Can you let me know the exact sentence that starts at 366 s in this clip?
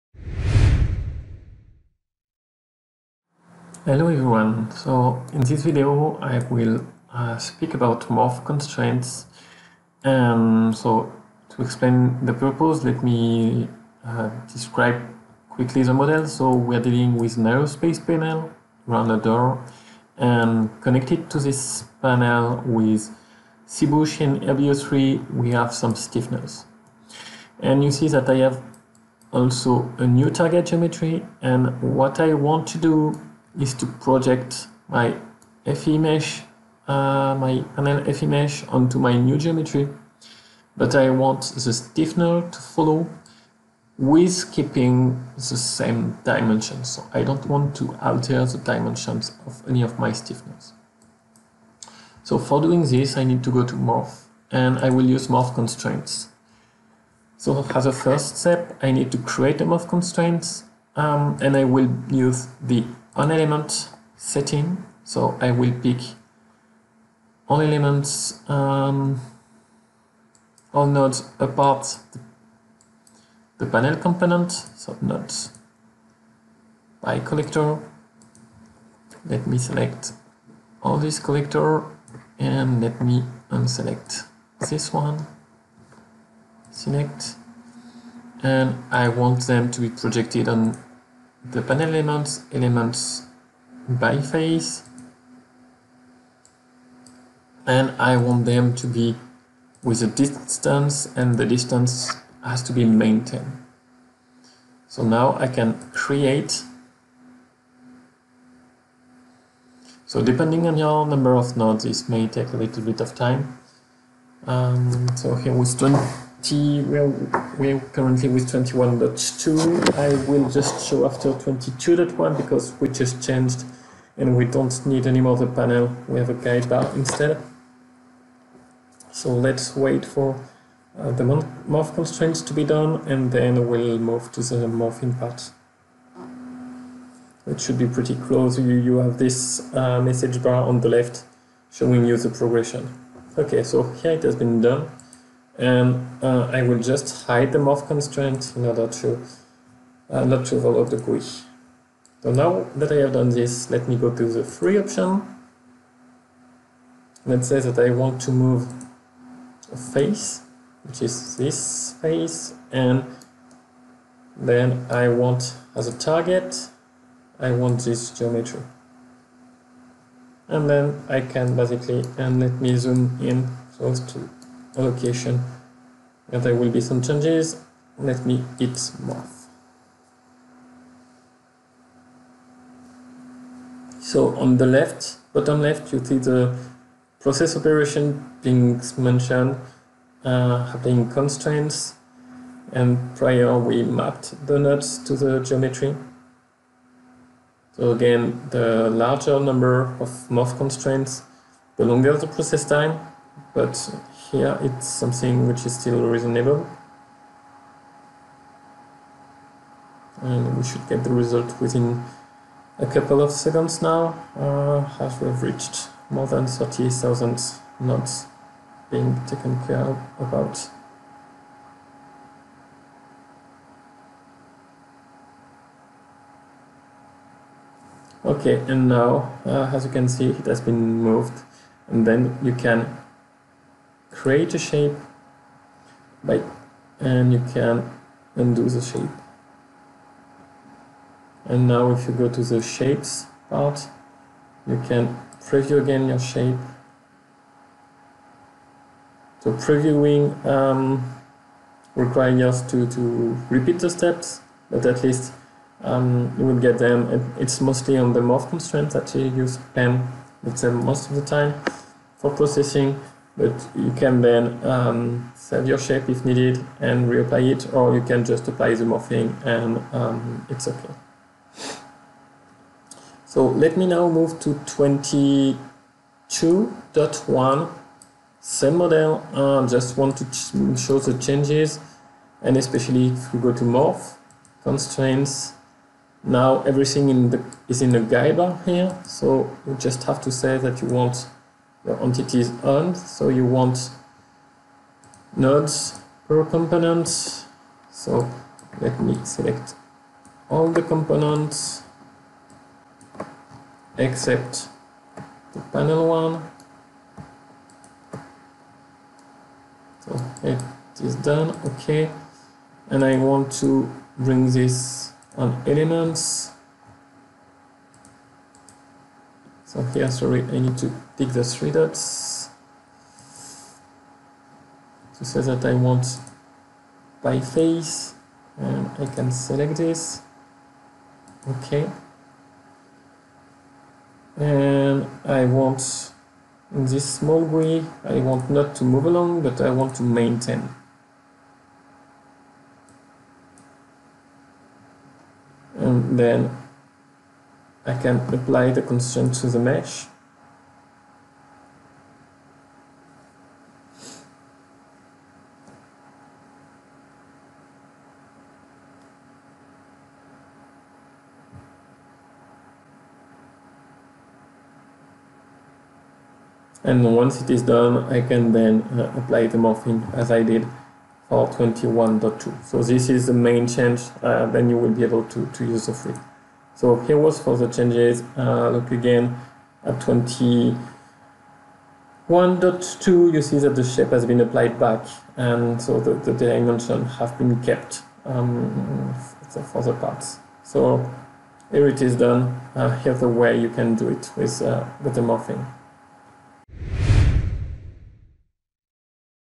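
And once it is done, I can then uh, apply the morphing as I did for 21.2.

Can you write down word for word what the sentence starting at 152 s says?
So now that I have done this, let me go to the free option.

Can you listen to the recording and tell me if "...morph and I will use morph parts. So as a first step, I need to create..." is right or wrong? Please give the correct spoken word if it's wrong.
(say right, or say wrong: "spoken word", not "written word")
wrong: "constraints", not "parts".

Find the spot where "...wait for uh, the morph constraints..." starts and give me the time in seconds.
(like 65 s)
129 s.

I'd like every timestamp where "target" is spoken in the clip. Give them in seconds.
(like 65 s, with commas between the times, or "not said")
30 s, 165 s.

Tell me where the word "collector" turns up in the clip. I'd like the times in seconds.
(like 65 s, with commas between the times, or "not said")
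77 s, 81 s.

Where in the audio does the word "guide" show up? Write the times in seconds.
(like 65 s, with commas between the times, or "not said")
126 s, 287 s.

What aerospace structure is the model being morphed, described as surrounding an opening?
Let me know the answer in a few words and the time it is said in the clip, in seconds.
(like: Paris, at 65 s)
Panel around a door, at 18 s.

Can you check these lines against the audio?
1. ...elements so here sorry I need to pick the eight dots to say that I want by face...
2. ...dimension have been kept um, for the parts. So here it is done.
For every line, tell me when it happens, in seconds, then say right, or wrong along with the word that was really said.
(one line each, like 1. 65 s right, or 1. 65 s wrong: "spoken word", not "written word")
1. 315 s wrong: "three", not "eight"
2. 386 s right.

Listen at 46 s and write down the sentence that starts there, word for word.
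So I don't want to alter the dimensions of any of my stiffeners.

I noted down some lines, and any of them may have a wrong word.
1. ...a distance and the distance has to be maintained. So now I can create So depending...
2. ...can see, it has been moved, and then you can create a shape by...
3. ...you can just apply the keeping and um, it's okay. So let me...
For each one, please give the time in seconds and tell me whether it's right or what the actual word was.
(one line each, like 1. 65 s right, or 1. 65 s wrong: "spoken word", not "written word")
1. 100 s right
2. 229 s right
3. 267 s wrong: "morphing", not "keeping".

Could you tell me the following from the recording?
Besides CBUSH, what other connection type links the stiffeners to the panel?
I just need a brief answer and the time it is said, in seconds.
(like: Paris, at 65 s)
LBO3, at 24 s.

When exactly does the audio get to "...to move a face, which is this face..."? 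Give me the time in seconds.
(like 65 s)
158 s.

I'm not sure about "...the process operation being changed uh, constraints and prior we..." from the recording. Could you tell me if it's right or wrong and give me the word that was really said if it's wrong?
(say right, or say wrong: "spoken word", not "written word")
wrong: "mentioned", not "changed".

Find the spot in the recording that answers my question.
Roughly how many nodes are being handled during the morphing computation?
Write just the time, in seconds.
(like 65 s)
216 s.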